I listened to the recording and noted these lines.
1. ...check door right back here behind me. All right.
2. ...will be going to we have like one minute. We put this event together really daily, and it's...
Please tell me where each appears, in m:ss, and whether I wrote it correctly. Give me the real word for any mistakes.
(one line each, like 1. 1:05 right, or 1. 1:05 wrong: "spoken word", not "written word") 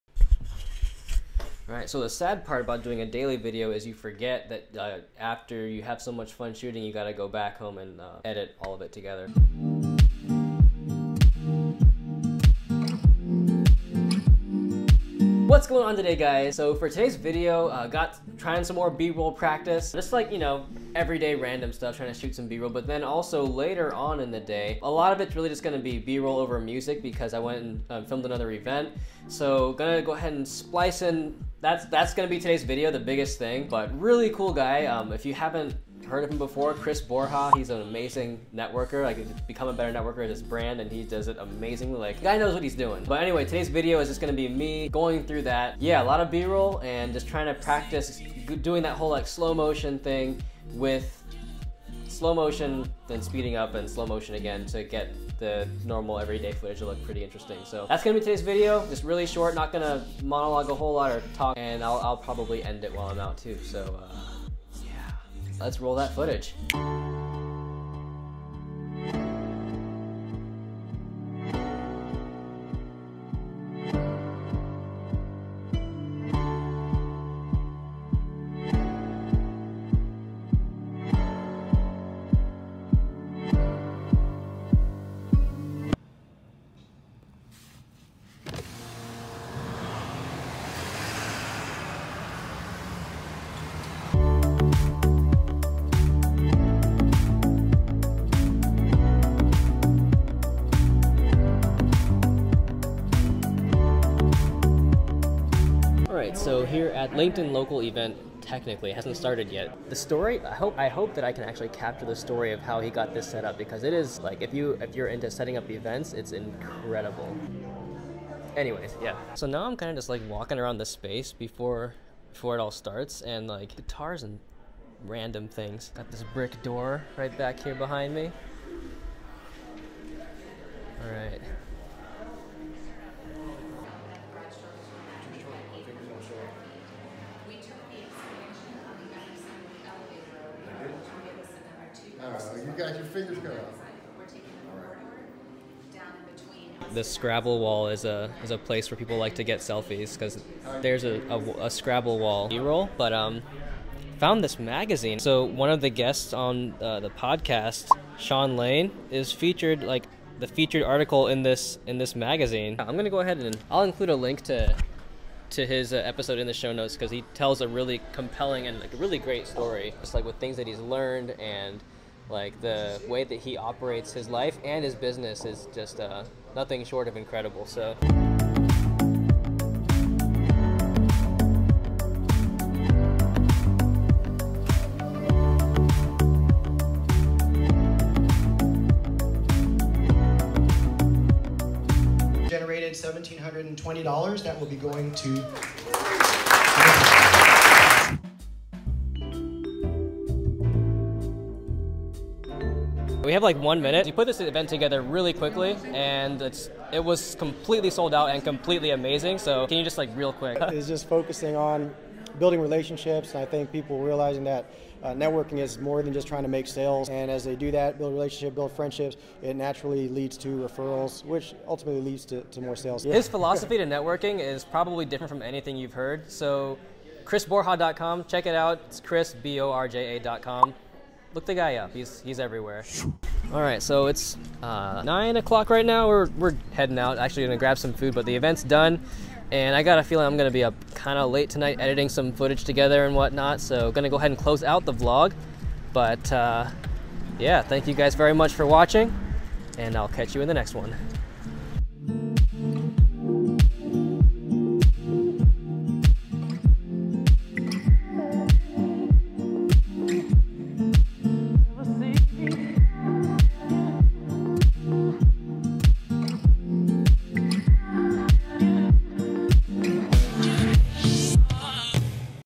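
1. 2:06 wrong: "brick", not "check"
2. 3:14 wrong: "quickly", not "daily".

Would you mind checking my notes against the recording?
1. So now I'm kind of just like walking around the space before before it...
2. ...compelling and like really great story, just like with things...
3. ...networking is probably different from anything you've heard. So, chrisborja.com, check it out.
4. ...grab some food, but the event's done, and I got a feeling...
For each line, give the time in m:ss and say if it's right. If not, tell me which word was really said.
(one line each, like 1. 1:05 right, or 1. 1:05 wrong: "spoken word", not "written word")
1. 1:59 right
2. 2:48 right
3. 3:43 right
4. 3:57 right.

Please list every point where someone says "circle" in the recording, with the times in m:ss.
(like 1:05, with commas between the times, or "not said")
not said.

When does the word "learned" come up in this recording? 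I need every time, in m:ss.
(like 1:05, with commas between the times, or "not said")
2:50.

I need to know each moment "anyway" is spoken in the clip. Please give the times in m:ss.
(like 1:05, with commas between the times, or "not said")
0:43, 1:58.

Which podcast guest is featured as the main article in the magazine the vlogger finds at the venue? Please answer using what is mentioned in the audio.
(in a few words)
Sean Lane.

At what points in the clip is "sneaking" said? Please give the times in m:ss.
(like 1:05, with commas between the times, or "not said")
not said.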